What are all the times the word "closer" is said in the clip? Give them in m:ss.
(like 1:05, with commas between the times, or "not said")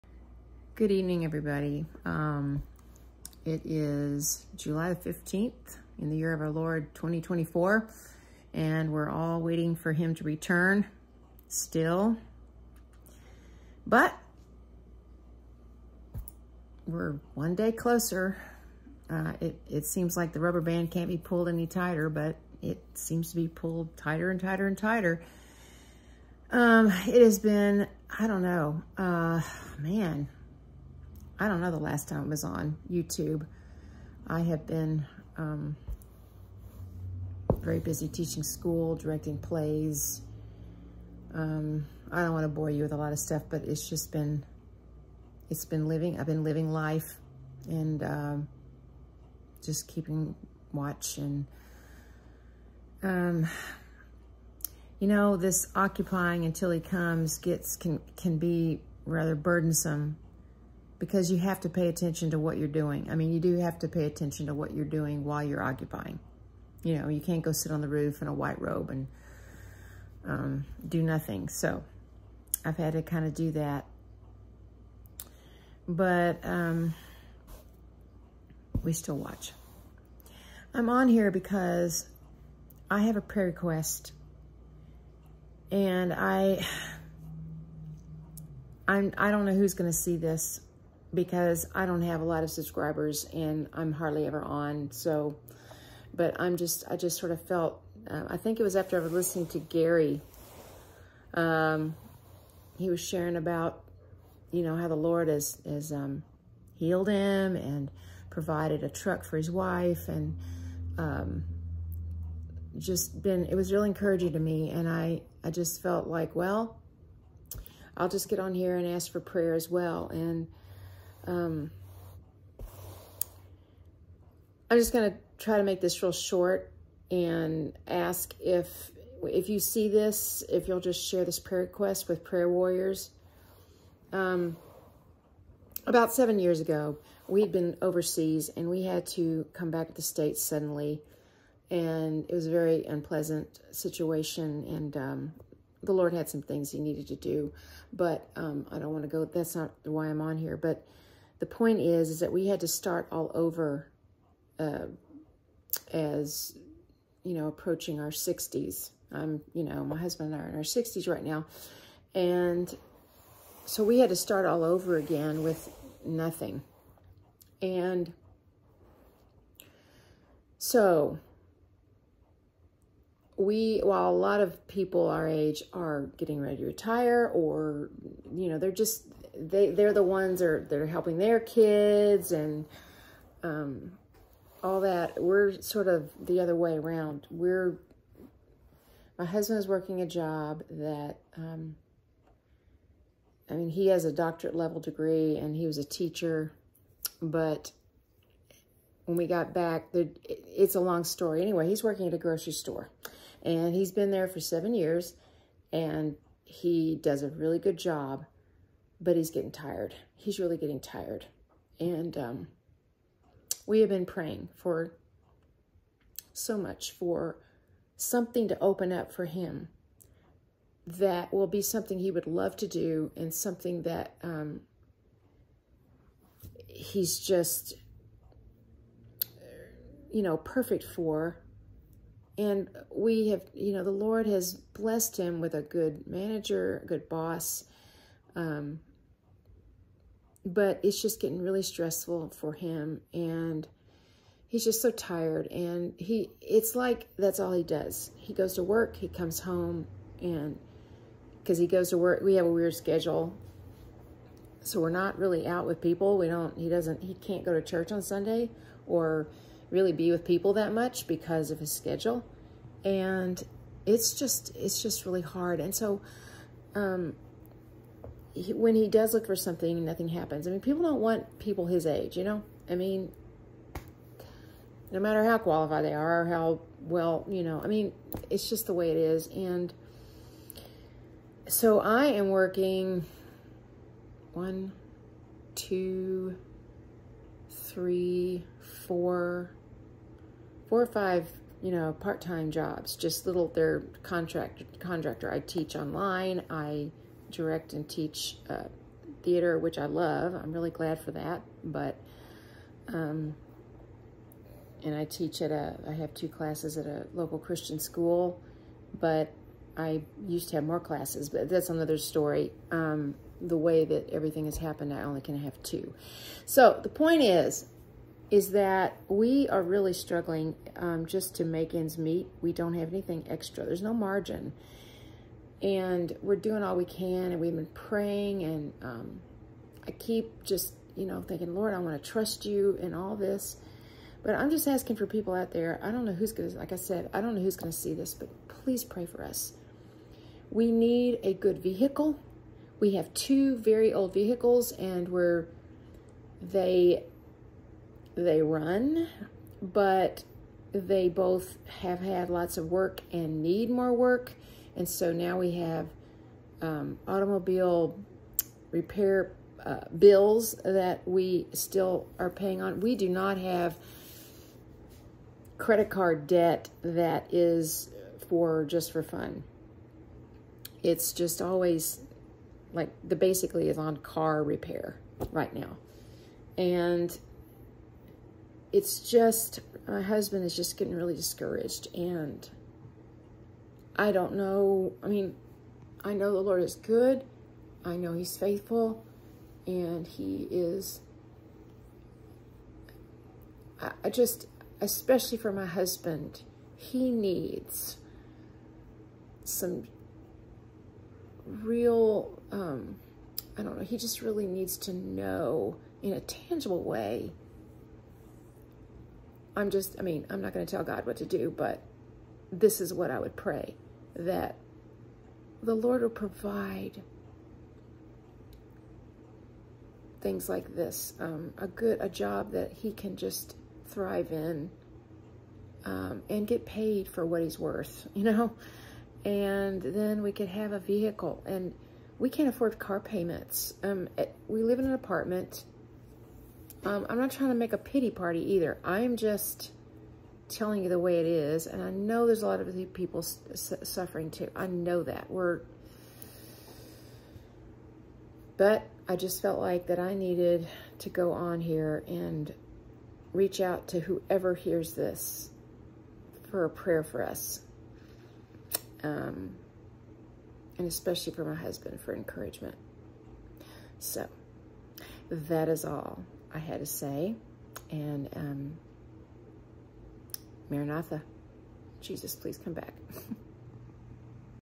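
0:17.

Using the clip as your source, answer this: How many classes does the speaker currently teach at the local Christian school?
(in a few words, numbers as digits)
2.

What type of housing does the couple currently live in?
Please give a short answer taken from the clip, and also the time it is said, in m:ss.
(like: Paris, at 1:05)
An apartment, at 7:14.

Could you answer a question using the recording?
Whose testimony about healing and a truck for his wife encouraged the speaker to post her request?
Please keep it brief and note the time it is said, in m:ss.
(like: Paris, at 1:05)
Gary, at 1:39.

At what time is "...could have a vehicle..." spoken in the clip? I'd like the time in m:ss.
7:10.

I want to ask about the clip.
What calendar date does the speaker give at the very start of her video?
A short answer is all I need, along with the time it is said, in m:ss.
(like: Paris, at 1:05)
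July 15th, at 0:04.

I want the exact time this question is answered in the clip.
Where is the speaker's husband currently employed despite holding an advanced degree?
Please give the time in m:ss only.
3:22.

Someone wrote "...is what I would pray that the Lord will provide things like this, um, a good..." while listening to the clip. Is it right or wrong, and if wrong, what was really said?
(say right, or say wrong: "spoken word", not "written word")
right.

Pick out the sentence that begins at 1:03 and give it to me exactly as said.
I mean, you do have to pay attention to what you're doing while you're occupying.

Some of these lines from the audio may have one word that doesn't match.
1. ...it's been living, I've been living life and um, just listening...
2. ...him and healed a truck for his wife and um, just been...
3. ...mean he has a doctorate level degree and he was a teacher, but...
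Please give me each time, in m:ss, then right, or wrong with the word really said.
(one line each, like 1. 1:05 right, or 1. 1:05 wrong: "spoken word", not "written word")
1. 0:45 wrong: "keeping", not "listening"
2. 1:47 wrong: "provided", not "healed"
3. 3:13 right.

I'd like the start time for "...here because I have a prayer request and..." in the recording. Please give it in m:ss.
1:21.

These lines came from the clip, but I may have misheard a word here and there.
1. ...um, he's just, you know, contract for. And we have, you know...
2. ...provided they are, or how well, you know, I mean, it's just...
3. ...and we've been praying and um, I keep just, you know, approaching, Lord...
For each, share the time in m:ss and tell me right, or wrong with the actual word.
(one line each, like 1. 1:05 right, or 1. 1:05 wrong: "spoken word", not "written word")
1. 3:44 wrong: "perfect", not "contract"
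2. 4:35 wrong: "qualified", not "provided"
3. 5:27 wrong: "thinking", not "approaching".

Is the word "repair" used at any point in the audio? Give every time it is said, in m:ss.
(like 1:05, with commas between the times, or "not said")
5:58, 6:14.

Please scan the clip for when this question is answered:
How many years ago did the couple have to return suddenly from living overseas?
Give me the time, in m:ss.
2:16.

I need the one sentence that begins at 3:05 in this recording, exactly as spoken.
We're sort of the other way around.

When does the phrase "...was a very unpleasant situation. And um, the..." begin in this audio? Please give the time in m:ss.
2:22.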